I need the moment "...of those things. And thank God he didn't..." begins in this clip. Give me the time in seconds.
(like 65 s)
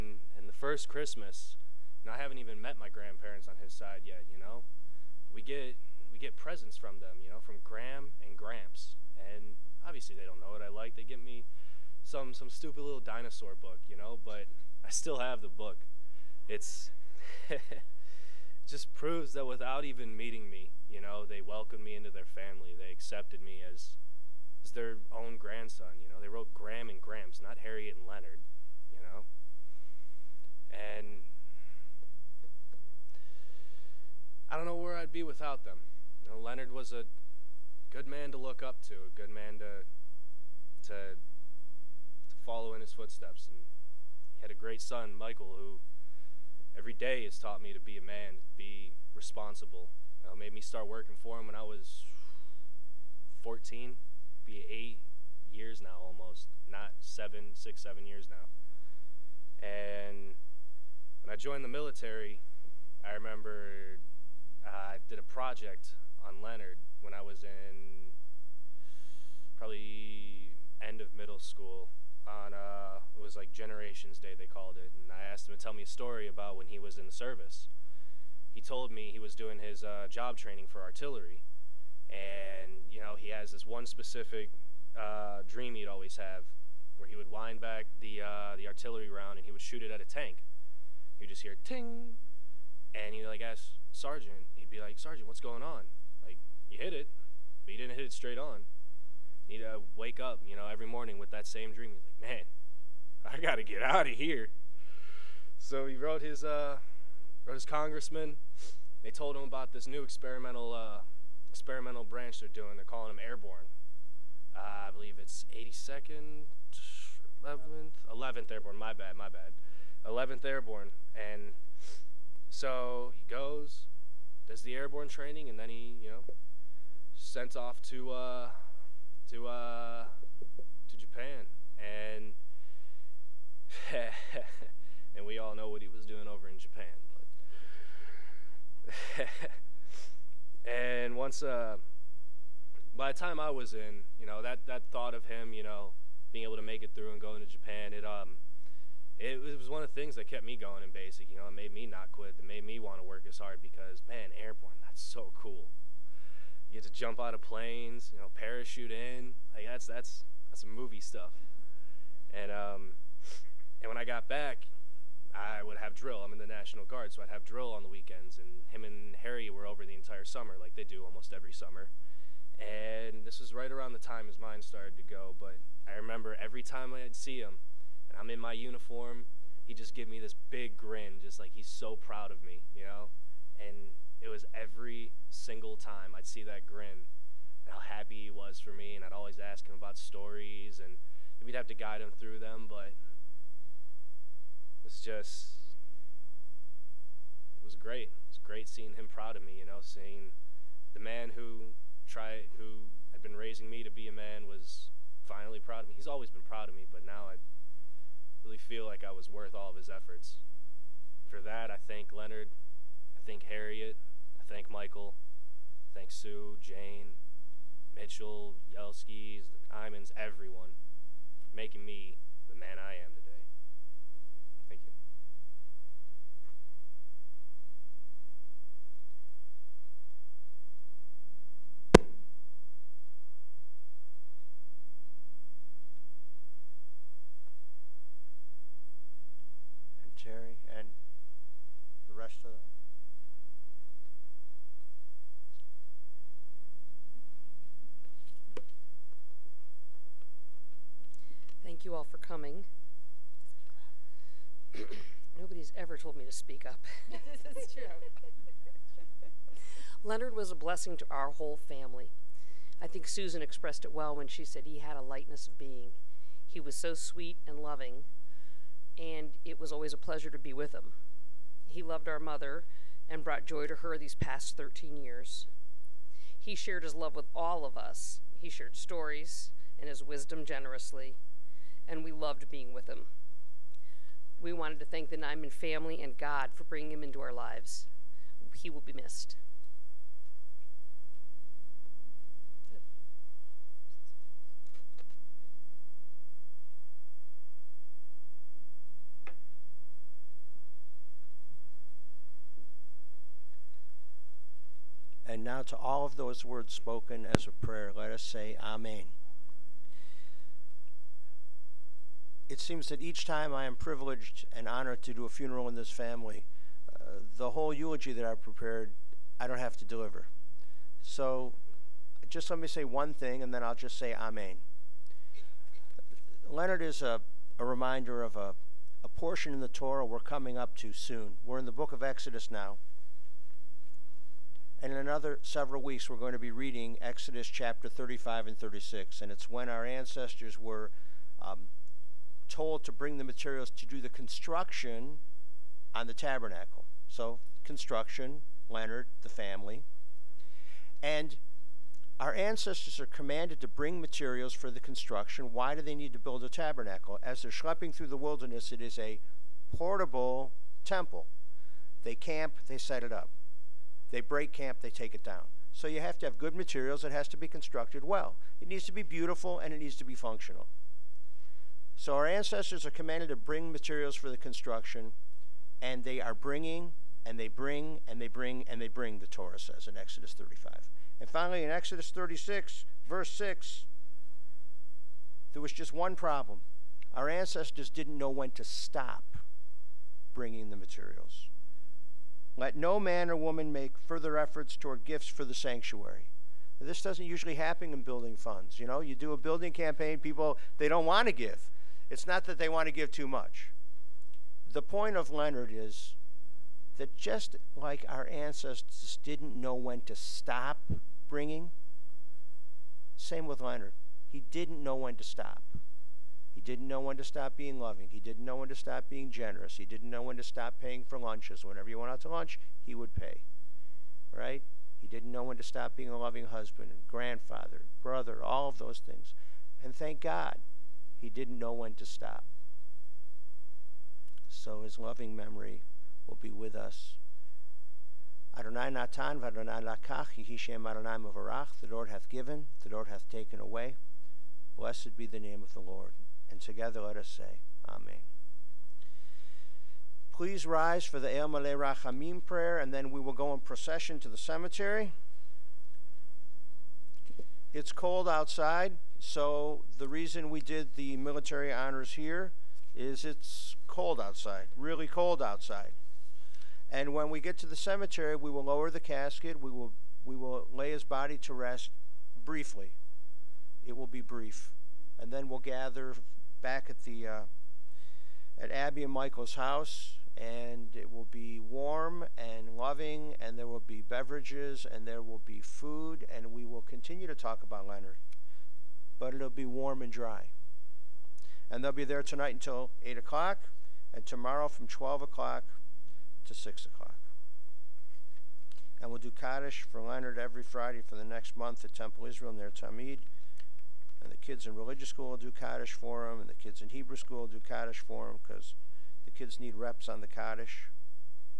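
428 s.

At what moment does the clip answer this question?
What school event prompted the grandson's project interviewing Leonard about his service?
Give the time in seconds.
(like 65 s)
73 s.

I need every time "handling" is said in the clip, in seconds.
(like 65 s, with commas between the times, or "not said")
not said.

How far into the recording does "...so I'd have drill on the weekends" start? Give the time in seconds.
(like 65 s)
167 s.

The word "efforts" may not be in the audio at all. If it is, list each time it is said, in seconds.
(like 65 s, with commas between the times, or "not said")
209 s, 394 s.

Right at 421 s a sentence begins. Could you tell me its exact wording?
Whenever you went out to lunch, he would pay.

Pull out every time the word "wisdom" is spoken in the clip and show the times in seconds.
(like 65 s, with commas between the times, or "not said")
280 s.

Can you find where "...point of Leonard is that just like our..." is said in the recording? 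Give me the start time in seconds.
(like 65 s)
404 s.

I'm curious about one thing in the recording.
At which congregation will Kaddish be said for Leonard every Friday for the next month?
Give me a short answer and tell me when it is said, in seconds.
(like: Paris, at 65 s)
Temple Israel Ner Tamid, at 501 s.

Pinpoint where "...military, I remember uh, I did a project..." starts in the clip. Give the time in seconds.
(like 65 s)
61 s.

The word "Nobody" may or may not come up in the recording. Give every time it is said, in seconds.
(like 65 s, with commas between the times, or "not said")
255 s.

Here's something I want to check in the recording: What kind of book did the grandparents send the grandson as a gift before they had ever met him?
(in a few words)
Dinosaur book.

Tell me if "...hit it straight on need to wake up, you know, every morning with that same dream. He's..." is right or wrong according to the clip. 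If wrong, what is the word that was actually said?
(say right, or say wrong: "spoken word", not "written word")
right.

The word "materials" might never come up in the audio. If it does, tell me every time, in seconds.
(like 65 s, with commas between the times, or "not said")
343 s, 354 s, 366 s, 373 s, 390 s.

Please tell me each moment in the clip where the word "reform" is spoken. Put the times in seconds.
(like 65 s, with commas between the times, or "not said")
not said.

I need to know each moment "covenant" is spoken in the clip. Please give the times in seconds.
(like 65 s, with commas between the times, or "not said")
not said.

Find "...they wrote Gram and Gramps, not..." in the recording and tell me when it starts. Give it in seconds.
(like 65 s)
26 s.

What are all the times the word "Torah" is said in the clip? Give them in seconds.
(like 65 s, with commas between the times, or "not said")
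329 s, 379 s.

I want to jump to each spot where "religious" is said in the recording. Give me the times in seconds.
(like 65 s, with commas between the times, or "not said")
504 s.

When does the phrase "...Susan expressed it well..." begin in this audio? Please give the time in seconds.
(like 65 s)
263 s.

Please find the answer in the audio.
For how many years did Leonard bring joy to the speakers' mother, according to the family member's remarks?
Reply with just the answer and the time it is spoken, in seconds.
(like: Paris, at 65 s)
13, at 274 s.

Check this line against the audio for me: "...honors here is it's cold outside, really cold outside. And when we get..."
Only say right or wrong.
right.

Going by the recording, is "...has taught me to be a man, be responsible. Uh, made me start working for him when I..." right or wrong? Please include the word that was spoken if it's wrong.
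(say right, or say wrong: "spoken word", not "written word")
right.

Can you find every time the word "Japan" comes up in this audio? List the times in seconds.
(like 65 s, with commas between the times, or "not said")
130 s, 136 s, 147 s.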